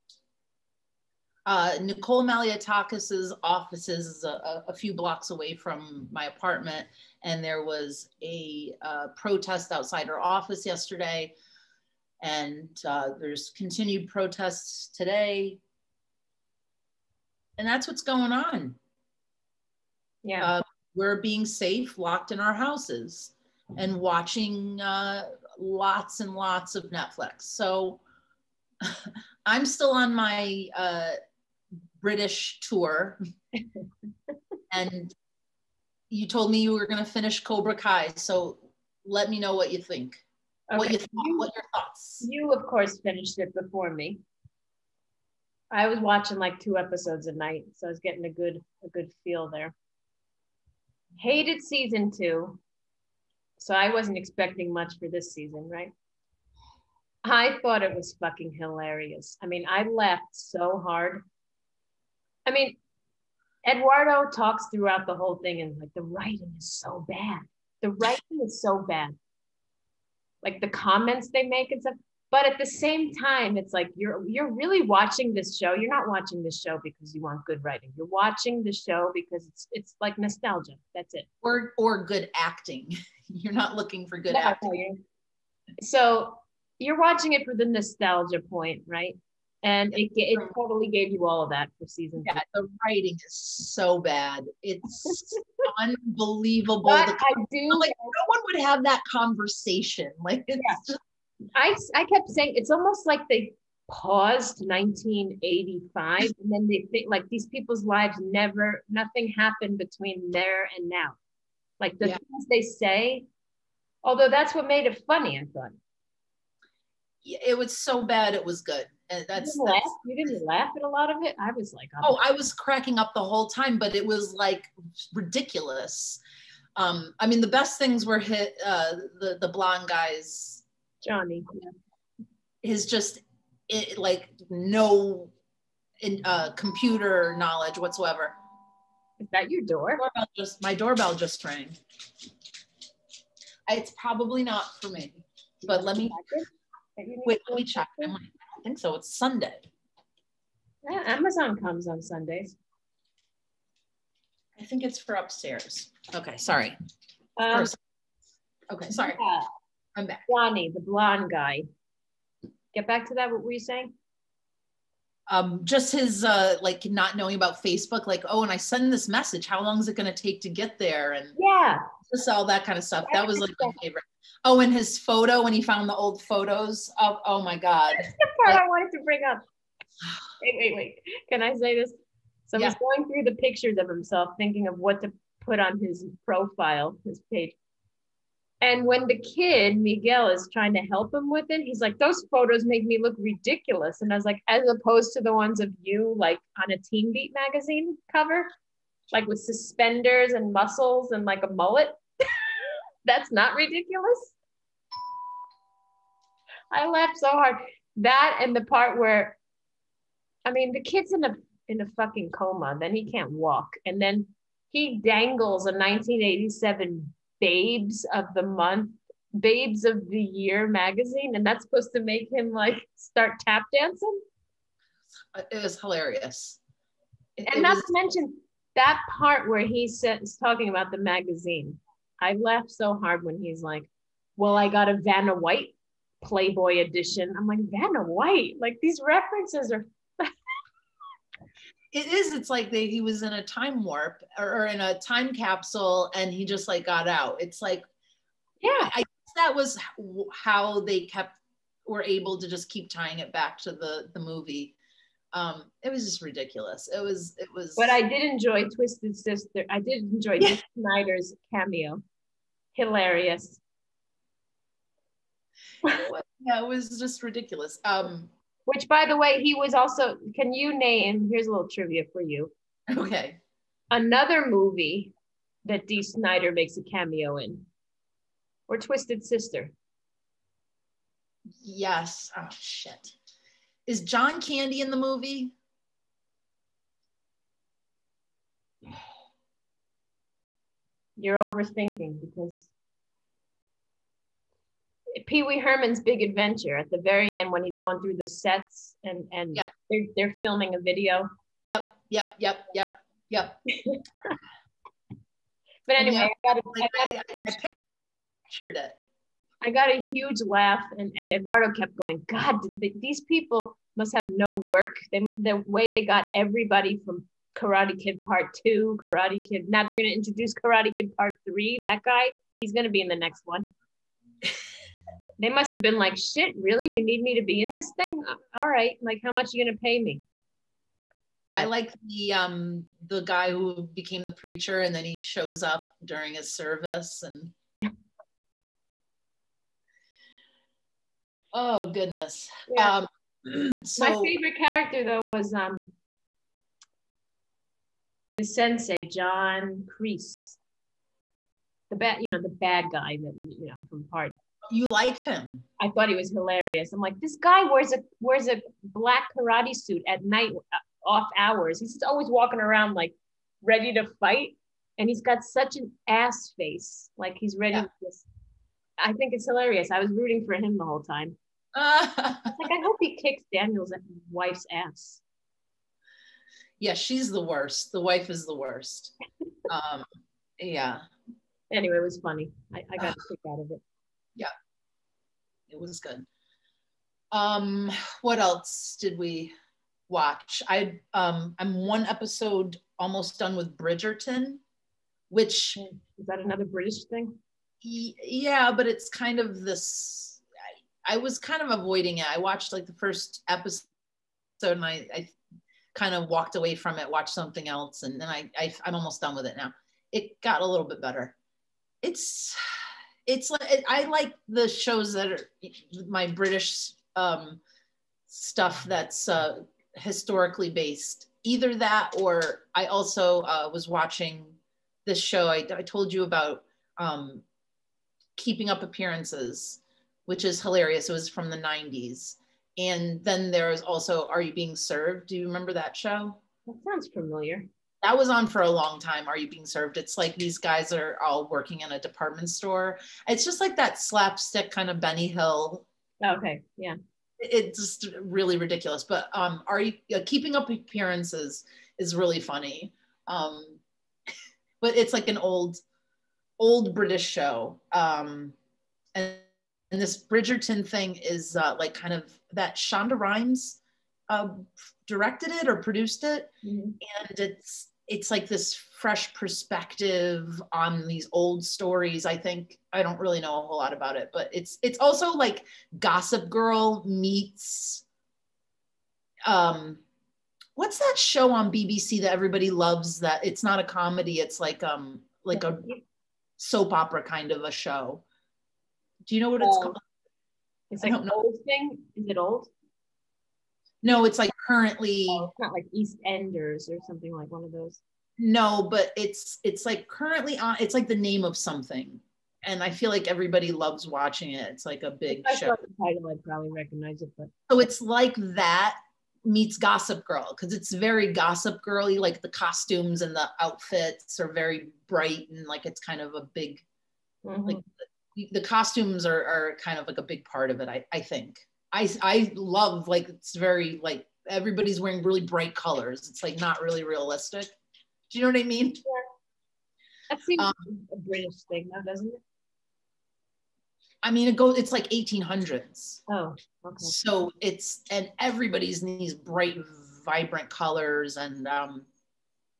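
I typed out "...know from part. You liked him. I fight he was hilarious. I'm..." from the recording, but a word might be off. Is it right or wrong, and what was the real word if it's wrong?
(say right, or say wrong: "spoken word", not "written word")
wrong: "thought", not "fight".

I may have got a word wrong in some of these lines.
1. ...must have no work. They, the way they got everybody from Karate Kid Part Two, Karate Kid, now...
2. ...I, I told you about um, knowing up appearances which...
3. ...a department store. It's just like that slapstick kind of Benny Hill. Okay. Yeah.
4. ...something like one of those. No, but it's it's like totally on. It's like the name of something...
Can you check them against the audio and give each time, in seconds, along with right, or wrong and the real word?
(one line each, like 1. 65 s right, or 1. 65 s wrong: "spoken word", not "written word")
1. 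313 s right
2. 425 s wrong: "keeping", not "knowing"
3. 441 s right
4. 497 s wrong: "currently", not "totally".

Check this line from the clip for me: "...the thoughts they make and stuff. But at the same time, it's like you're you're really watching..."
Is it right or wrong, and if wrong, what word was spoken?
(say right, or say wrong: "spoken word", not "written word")
wrong: "comments", not "thoughts".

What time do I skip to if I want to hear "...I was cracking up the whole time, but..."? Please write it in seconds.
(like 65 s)
122 s.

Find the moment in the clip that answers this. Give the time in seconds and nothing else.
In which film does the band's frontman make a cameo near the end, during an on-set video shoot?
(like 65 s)
295 s.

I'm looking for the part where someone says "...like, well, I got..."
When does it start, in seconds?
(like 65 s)
233 s.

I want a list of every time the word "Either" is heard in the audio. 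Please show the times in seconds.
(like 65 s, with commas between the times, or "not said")
421 s.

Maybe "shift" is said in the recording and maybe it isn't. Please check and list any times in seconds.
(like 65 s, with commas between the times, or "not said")
not said.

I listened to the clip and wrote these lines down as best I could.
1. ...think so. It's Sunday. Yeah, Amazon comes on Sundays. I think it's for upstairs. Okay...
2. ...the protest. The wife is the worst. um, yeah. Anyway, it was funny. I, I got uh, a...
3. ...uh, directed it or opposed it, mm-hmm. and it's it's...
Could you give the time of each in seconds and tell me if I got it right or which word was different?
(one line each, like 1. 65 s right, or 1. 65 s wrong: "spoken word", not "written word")
1. 148 s right
2. 377 s wrong: "worst", not "protest"
3. 464 s wrong: "produced", not "opposed".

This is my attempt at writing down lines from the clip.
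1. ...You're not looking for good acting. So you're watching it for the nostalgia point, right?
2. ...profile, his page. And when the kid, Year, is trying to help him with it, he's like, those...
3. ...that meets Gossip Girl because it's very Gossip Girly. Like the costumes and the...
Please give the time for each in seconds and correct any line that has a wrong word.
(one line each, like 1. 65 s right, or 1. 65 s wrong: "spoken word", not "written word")
1. 83 s right
2. 186 s wrong: "Miguel", not "Year"
3. 508 s right.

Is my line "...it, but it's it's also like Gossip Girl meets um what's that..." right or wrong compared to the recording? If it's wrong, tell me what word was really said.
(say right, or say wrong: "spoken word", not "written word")
right.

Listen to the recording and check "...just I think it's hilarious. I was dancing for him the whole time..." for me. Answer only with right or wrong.
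wrong.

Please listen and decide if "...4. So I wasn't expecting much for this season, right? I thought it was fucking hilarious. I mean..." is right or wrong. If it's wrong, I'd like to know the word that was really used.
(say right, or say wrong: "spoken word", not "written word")
wrong: "2", not "4".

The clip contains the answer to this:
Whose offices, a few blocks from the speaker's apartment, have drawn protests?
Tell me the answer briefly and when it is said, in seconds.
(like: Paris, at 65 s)
Nicole Malliotakis, at 1 s.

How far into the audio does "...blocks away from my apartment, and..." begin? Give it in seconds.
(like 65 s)
4 s.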